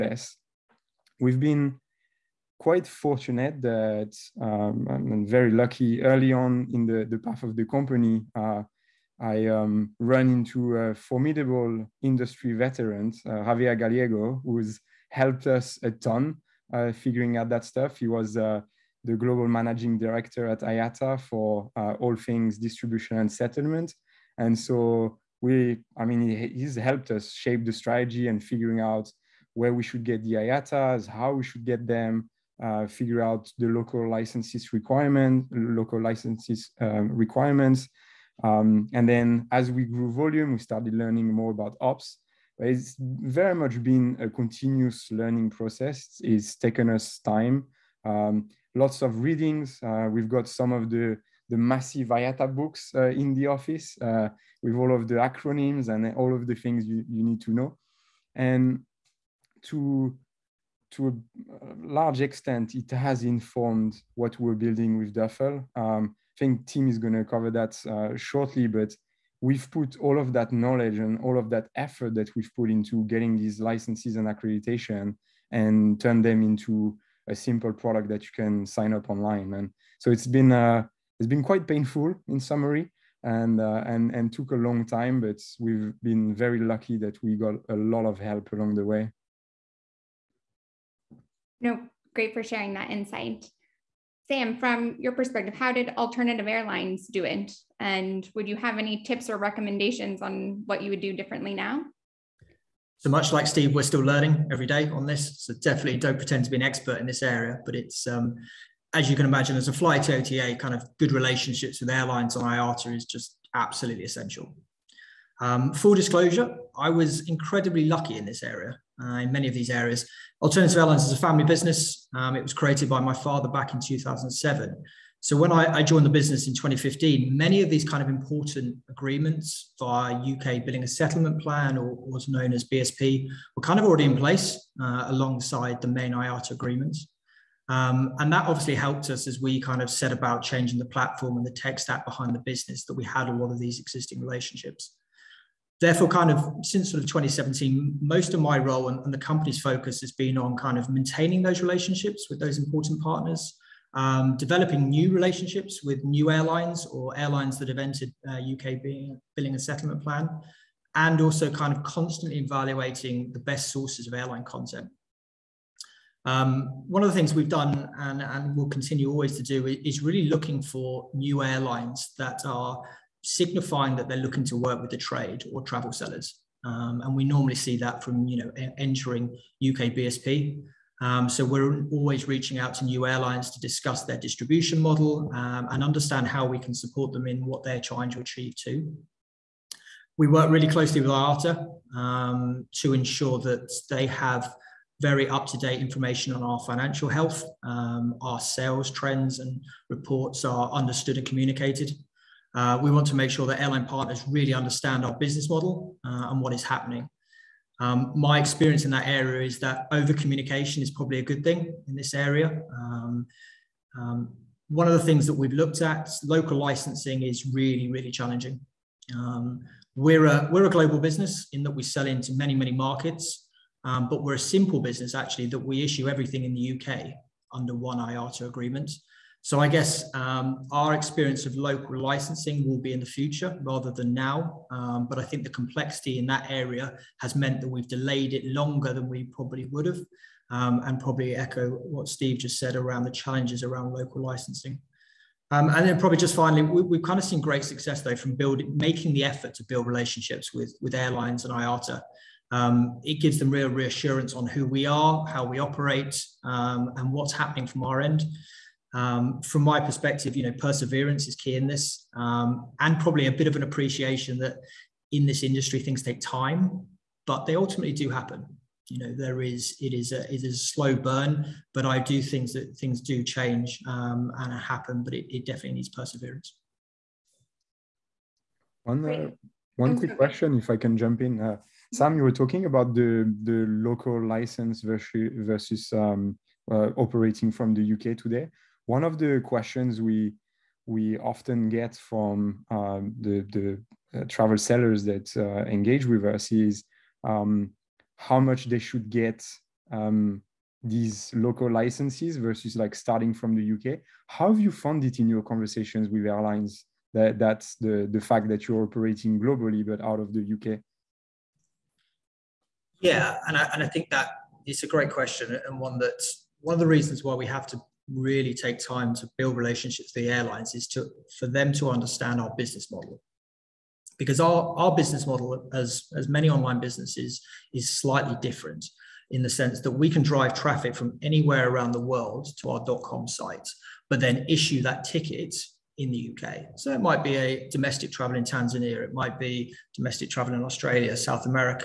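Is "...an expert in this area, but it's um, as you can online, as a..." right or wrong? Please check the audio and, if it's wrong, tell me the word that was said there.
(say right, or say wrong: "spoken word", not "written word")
wrong: "imagine", not "online".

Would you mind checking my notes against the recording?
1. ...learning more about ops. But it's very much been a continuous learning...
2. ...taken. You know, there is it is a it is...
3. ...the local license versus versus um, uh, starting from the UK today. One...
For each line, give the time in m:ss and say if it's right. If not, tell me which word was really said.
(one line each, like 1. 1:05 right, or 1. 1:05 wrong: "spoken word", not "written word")
1. 0:40 right
2. 4:28 wrong: "happen", not "taken"
3. 4:43 wrong: "operating", not "starting".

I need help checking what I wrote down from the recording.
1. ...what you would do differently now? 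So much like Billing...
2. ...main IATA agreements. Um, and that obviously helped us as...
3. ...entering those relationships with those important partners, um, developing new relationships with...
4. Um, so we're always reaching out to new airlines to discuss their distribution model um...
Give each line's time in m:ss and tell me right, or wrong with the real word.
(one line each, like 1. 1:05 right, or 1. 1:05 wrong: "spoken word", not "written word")
1. 1:40 wrong: "Steve", not "Billing"
2. 2:15 right
3. 2:30 wrong: "maintaining", not "entering"
4. 3:01 right.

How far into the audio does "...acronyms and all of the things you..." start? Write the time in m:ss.
0:55.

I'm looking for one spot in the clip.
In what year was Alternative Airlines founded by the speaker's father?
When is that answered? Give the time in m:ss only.
2:03.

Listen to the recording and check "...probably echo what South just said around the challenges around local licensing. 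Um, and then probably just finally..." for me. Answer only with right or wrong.
wrong.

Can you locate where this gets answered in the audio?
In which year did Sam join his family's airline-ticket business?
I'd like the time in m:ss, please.
2:06.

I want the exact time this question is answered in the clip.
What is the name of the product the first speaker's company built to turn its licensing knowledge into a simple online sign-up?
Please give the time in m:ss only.
1:05.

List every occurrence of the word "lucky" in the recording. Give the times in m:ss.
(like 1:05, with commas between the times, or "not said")
0:05, 1:26, 1:57.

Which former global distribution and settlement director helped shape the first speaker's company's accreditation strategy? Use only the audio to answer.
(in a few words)
Javier Gallego.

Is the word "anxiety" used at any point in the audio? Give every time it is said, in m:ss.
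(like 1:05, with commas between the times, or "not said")
not said.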